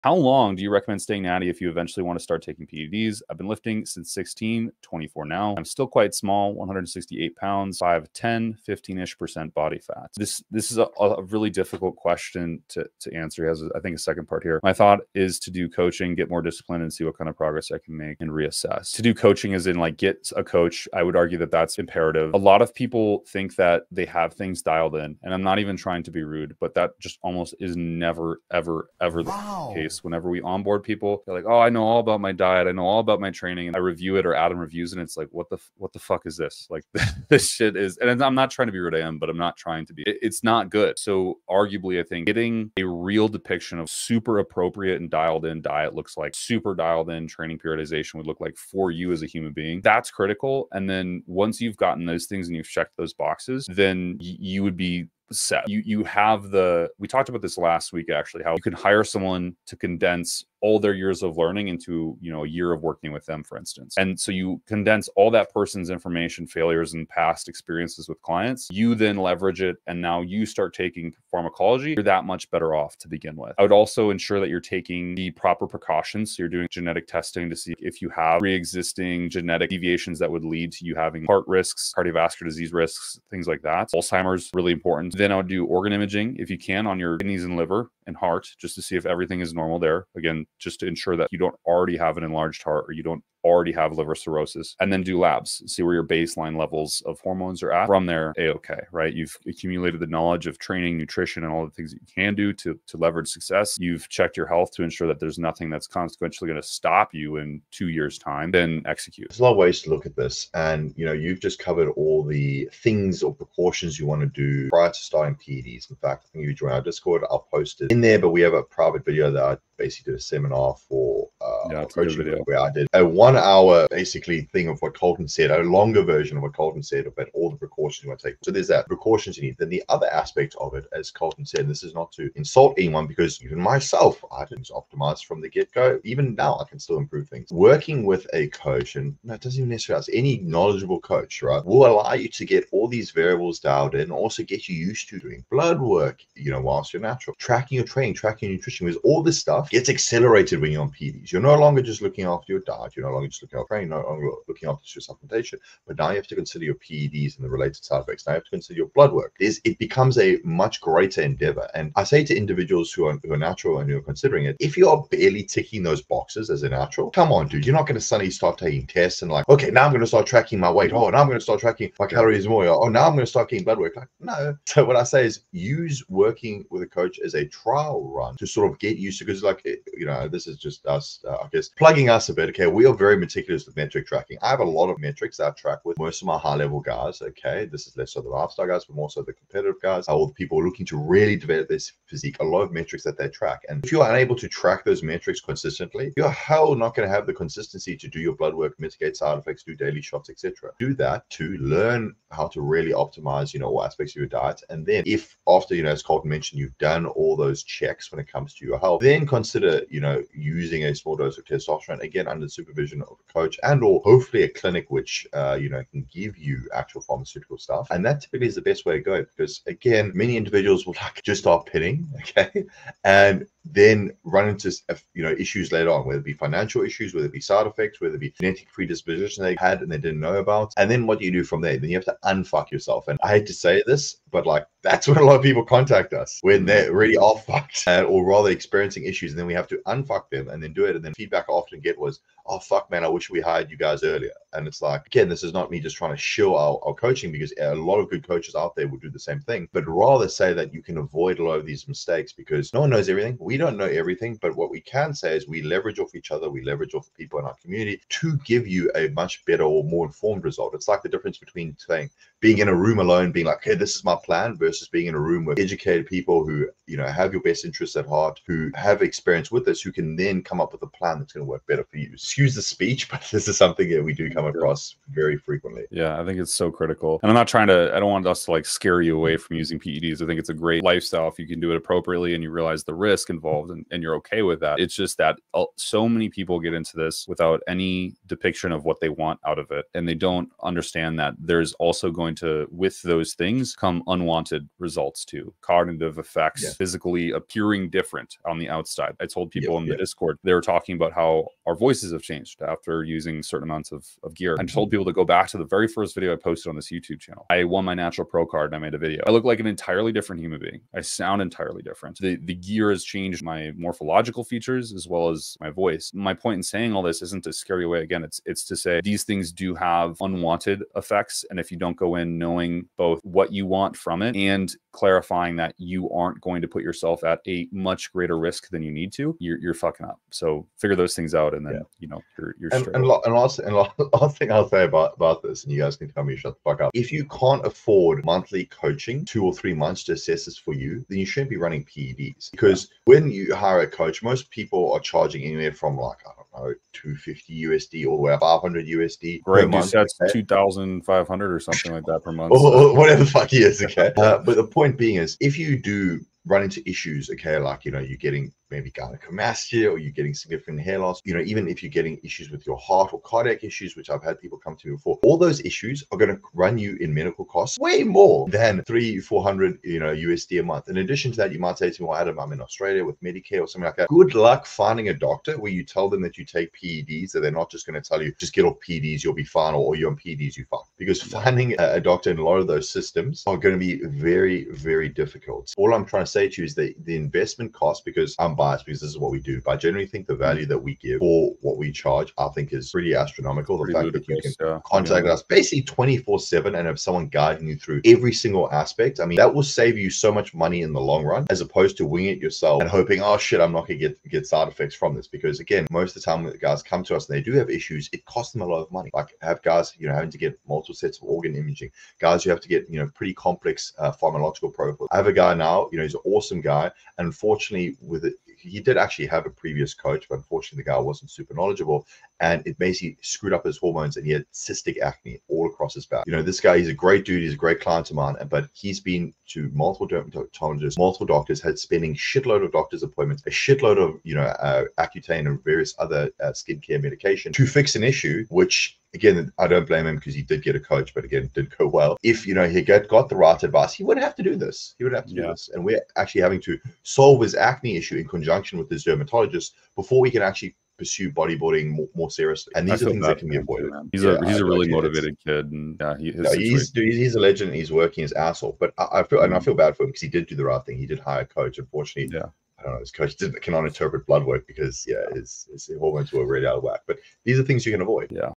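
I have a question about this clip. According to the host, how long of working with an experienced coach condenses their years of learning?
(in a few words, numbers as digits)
a year.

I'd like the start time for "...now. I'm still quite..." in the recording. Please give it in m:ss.
0:05.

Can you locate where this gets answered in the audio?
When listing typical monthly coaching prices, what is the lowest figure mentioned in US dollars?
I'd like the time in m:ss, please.
5:46.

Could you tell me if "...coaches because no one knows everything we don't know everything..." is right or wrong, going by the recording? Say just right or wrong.
wrong.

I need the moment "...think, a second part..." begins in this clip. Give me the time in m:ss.
0:13.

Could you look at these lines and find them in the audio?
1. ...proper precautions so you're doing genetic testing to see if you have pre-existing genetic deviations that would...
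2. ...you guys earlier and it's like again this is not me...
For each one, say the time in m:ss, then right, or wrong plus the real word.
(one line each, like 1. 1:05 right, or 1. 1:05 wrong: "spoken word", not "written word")
1. 1:15 right
2. 4:03 right.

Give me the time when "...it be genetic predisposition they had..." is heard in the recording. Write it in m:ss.
3:48.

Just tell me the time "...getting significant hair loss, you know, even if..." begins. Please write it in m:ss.
6:00.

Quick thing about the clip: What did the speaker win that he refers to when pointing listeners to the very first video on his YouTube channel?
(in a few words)
natural pro card.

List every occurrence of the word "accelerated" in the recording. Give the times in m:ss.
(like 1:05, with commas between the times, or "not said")
2:29.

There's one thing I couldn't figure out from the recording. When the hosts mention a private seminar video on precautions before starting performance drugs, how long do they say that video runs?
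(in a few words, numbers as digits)
1 hour.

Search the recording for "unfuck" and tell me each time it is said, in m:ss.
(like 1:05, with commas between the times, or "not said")
3:52, 3:59.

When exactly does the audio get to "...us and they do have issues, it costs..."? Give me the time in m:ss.
6:47.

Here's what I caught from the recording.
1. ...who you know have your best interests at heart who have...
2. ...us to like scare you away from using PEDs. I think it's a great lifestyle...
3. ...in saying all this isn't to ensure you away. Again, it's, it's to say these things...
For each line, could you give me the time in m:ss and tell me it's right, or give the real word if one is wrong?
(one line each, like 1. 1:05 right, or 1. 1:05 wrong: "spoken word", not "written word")
1. 4:26 right
2. 4:38 right
3. 5:16 wrong: "scare", not "ensure".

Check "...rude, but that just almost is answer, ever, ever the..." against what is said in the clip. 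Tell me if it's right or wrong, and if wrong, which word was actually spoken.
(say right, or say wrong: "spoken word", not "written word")
wrong: "never", not "answer".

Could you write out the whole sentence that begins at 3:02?
Okay, we are very meticulous with metric tracking.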